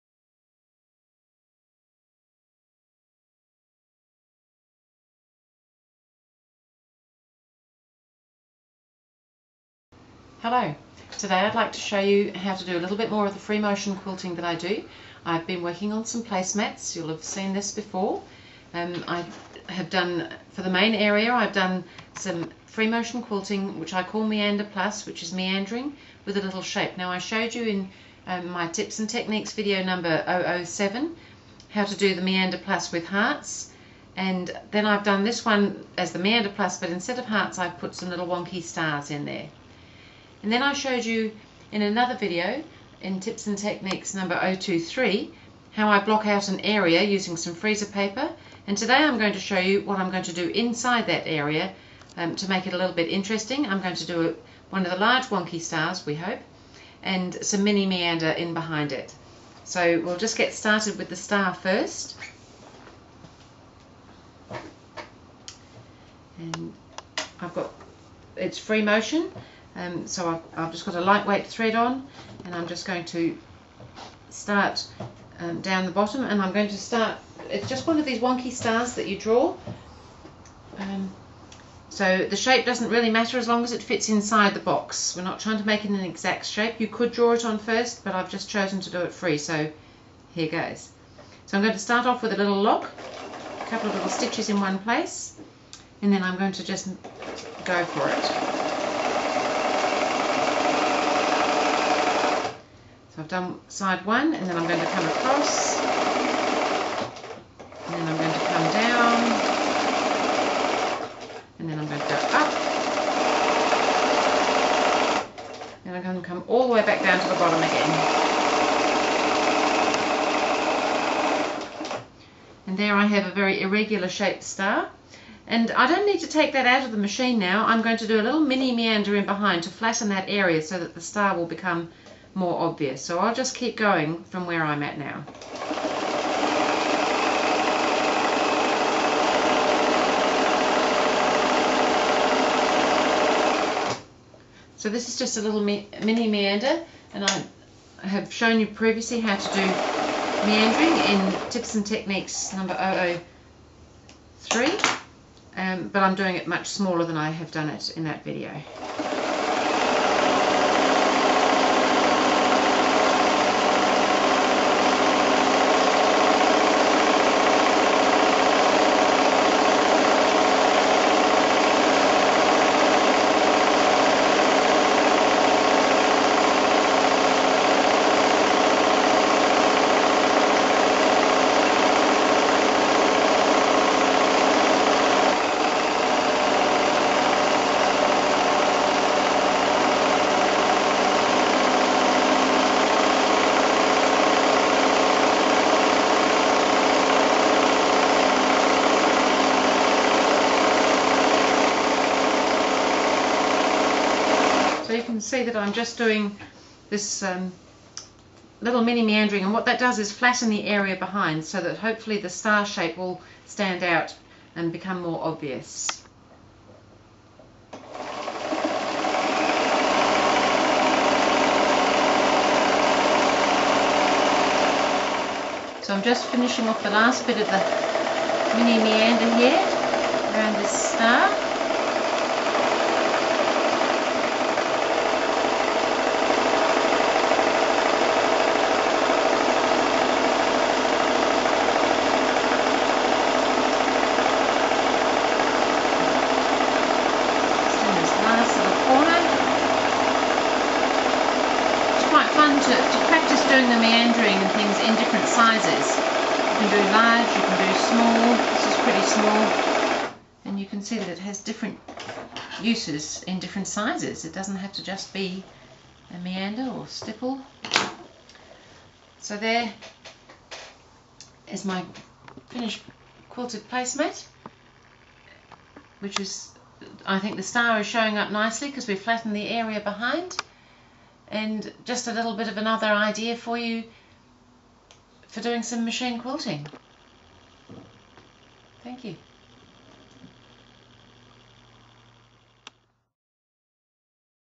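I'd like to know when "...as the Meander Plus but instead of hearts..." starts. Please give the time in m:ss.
0:35.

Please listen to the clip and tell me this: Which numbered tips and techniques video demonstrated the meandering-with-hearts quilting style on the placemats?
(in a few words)
007.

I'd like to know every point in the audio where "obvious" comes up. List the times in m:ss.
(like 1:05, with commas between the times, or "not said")
2:12, 3:35.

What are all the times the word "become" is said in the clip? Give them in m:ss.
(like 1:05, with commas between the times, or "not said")
2:11, 3:34.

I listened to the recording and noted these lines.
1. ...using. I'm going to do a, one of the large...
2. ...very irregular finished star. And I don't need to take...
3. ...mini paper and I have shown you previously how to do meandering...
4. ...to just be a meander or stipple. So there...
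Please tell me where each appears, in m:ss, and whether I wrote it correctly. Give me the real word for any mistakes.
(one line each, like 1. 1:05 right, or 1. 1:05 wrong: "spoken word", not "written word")
1. 0:53 wrong: "interesting", not "using"
2. 2:03 wrong: "shaped", not "finished"
3. 2:25 wrong: "meander", not "paper"
4. 4:24 right.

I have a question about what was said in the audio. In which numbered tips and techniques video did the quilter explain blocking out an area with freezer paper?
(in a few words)
023.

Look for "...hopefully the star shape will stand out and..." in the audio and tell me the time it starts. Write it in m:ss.
3:31.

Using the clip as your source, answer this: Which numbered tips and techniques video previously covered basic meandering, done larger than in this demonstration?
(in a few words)
003.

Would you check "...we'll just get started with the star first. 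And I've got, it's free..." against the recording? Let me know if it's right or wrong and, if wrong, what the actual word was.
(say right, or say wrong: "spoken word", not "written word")
right.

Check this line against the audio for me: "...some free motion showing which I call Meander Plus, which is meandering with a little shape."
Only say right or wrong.
wrong.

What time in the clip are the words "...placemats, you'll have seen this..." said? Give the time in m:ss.
0:16.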